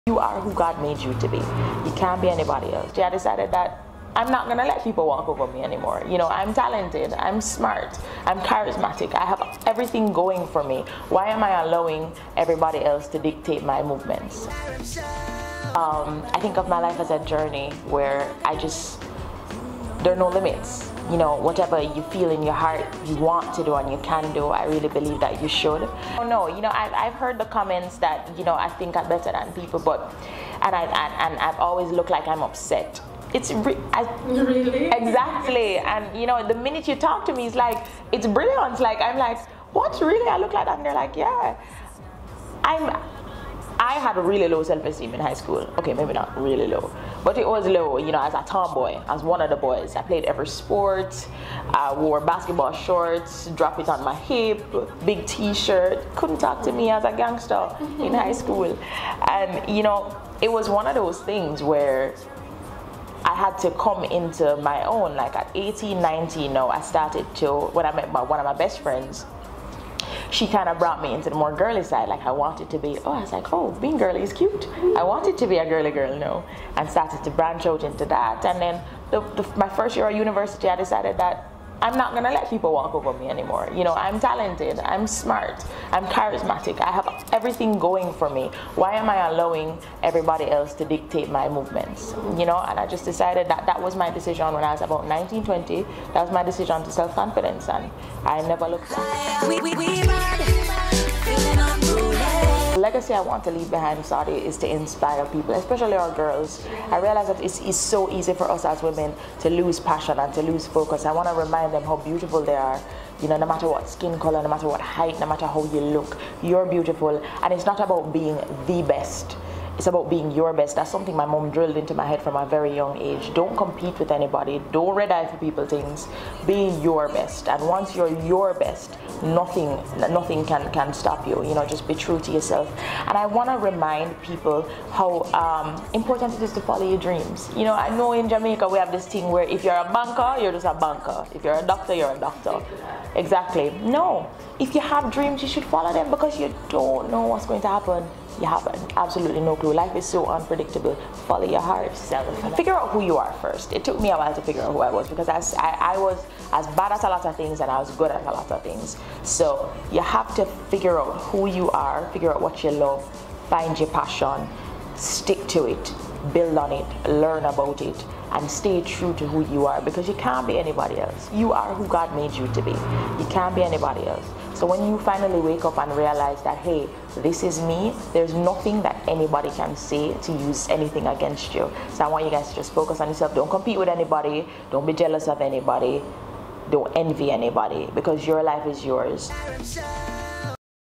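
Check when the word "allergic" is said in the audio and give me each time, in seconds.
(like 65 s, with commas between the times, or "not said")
not said.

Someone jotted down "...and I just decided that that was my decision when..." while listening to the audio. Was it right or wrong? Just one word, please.
right.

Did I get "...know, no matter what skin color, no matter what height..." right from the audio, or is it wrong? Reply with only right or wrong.
right.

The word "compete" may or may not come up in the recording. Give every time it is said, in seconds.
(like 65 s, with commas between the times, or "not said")
123 s, 183 s.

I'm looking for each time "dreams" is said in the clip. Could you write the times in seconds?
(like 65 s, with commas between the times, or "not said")
136 s, 145 s.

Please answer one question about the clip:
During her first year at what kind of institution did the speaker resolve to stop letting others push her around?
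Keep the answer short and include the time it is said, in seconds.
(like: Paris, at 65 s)
University, at 80 s.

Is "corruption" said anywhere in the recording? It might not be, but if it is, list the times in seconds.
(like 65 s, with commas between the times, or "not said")
not said.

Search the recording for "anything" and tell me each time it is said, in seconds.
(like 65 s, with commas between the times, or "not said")
180 s.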